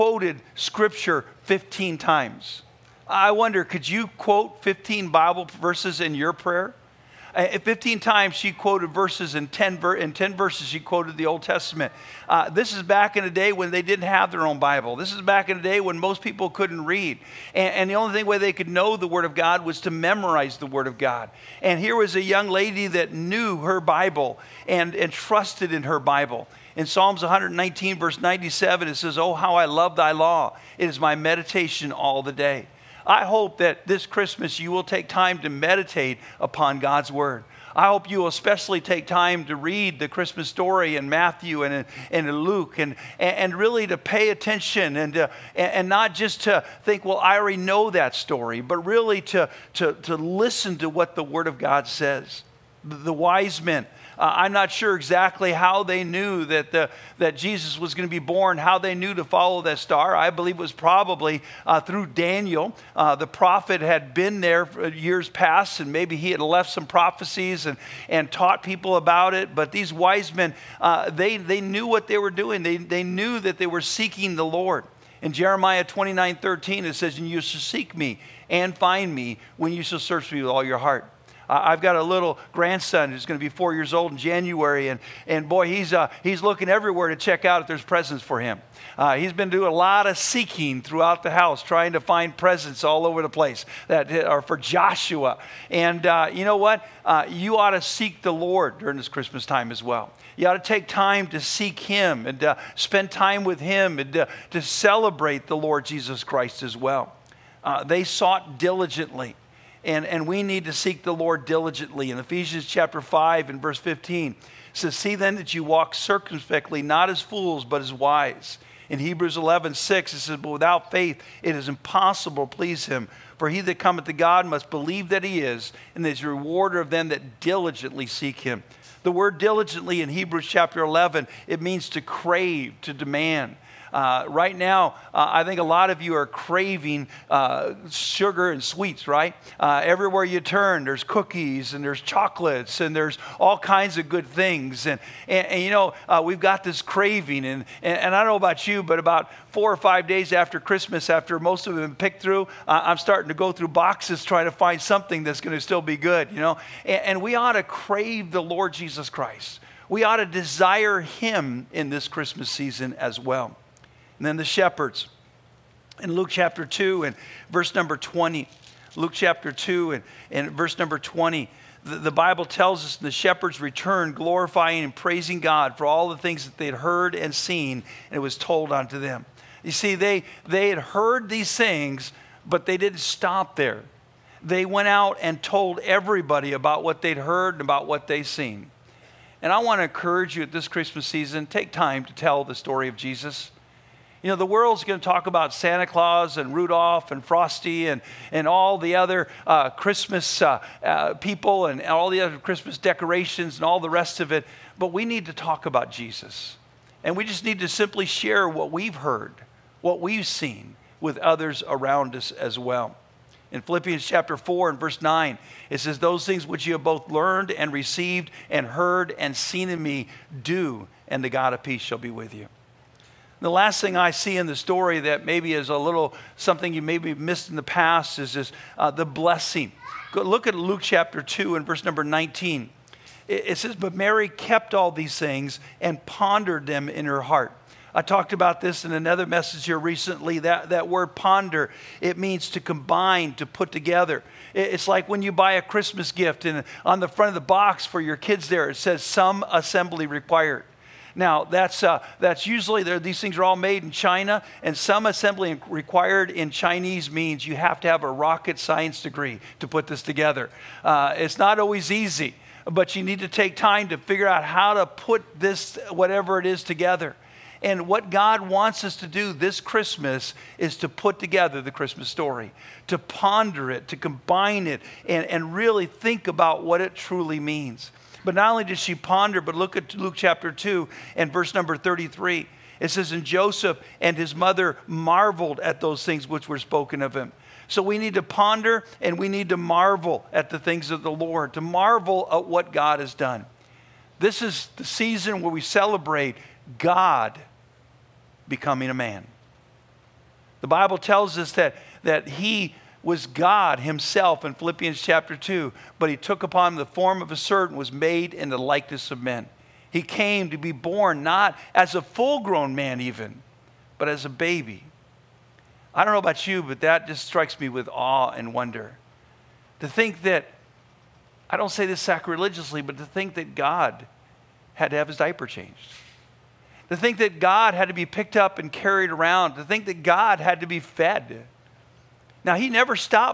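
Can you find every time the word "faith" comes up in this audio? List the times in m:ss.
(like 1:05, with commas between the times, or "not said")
2:00.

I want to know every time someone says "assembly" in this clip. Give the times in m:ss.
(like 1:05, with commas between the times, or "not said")
4:09, 4:15.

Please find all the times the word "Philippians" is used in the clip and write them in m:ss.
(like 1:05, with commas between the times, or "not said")
3:33, 5:04.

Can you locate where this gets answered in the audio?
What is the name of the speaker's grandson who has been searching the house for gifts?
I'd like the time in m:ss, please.
1:34.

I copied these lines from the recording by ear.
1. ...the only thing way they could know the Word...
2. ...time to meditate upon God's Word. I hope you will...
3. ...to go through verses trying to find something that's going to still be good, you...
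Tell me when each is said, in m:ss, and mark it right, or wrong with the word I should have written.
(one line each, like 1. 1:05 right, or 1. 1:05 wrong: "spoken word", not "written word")
1. 0:17 right
2. 0:35 right
3. 2:33 wrong: "boxes", not "verses".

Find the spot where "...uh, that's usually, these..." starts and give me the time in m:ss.
4:11.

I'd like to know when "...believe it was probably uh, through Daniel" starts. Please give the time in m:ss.
1:00.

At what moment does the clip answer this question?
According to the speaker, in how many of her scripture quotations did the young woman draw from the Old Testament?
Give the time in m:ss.
0:09.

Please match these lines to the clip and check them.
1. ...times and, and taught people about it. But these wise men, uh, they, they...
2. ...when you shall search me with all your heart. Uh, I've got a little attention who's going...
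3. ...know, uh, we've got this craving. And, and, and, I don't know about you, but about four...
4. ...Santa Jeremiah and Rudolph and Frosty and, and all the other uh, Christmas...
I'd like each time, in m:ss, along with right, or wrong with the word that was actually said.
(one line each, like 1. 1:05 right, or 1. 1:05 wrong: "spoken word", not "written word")
1. 1:06 wrong: "prophecies", not "times"
2. 1:19 wrong: "grandson", not "attention"
3. 2:25 right
4. 3:15 wrong: "Claus", not "Jeremiah".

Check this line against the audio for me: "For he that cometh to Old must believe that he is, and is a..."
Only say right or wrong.
wrong.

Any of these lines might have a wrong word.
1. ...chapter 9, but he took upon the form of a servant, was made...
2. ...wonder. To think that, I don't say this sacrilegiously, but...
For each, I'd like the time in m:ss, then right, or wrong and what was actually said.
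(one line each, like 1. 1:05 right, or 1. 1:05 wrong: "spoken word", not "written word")
1. 5:05 wrong: "2", not "9"
2. 5:18 right.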